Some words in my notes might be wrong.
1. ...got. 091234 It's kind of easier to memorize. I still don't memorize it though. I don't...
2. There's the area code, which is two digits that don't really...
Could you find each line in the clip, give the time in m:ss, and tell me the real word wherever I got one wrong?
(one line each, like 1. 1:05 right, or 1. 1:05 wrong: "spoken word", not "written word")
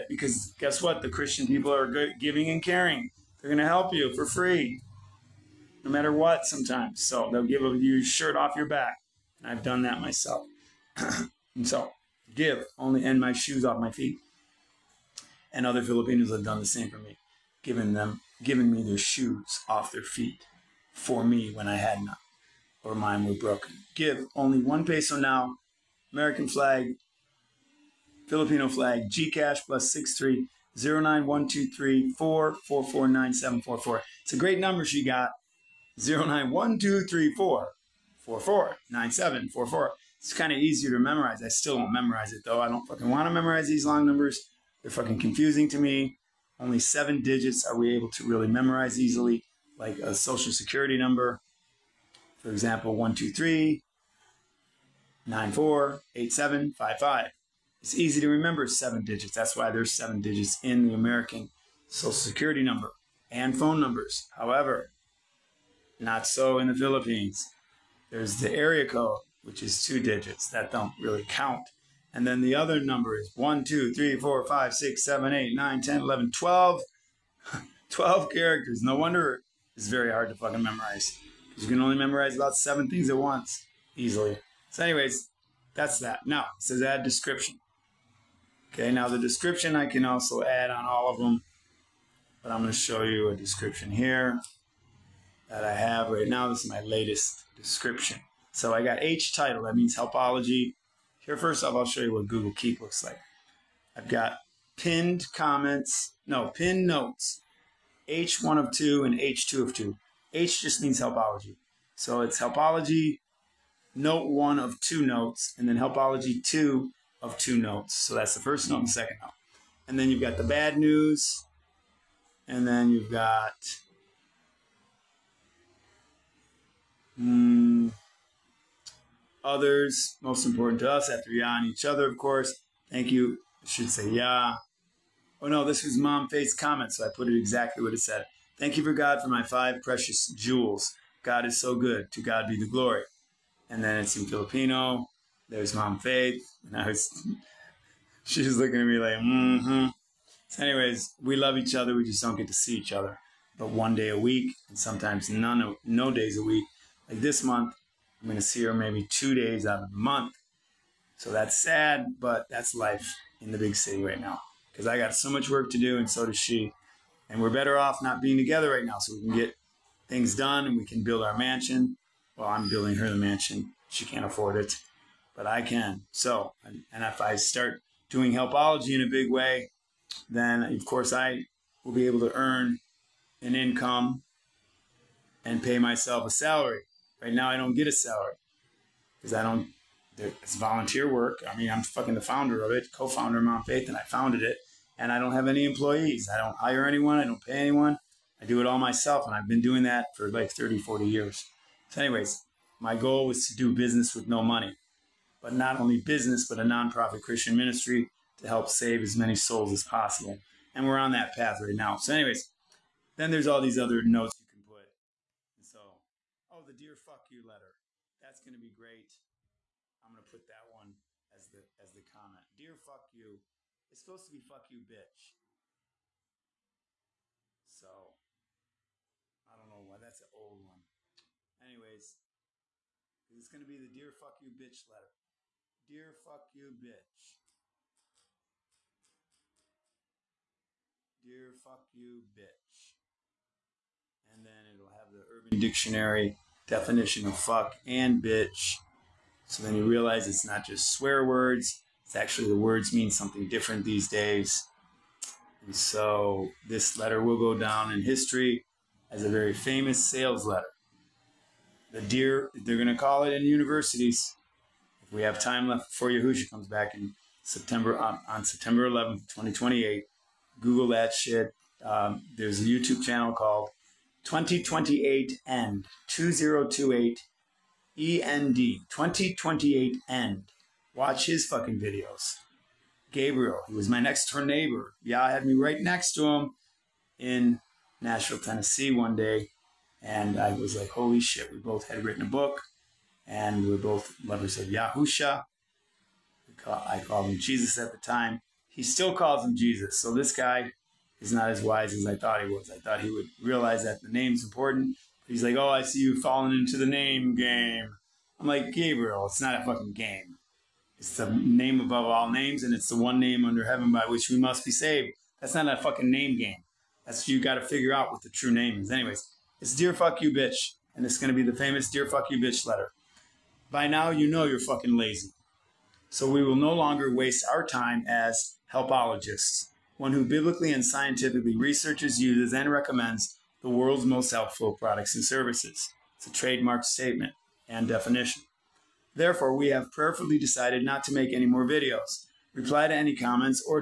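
1. 0:35 right
2. 1:08 right.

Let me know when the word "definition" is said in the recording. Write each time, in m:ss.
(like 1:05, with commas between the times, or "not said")
4:06, 5:37.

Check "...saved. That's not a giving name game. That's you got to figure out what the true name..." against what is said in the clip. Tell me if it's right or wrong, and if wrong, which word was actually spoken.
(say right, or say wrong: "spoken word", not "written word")
wrong: "fucking", not "giving".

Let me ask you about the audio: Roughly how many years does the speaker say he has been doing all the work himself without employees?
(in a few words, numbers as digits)
30 to 40.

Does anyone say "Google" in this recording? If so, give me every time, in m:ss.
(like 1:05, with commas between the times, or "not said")
1:42, 4:30.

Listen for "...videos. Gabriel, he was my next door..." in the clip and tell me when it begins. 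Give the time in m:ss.
4:41.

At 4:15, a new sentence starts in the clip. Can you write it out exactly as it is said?
And so this letter will go down in history as a very famous sales letter.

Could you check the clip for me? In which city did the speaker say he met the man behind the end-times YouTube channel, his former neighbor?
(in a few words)
Nashville.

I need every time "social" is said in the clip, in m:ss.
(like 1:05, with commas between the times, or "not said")
0:50, 1:01.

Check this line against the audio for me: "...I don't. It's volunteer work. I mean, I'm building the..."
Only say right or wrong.
wrong.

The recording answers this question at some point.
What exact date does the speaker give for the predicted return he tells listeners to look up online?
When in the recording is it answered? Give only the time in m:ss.
4:28.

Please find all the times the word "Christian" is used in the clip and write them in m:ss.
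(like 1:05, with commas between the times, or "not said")
0:01, 3:27.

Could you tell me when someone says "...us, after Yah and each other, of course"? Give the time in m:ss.
2:10.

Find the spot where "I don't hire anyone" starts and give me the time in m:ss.
3:16.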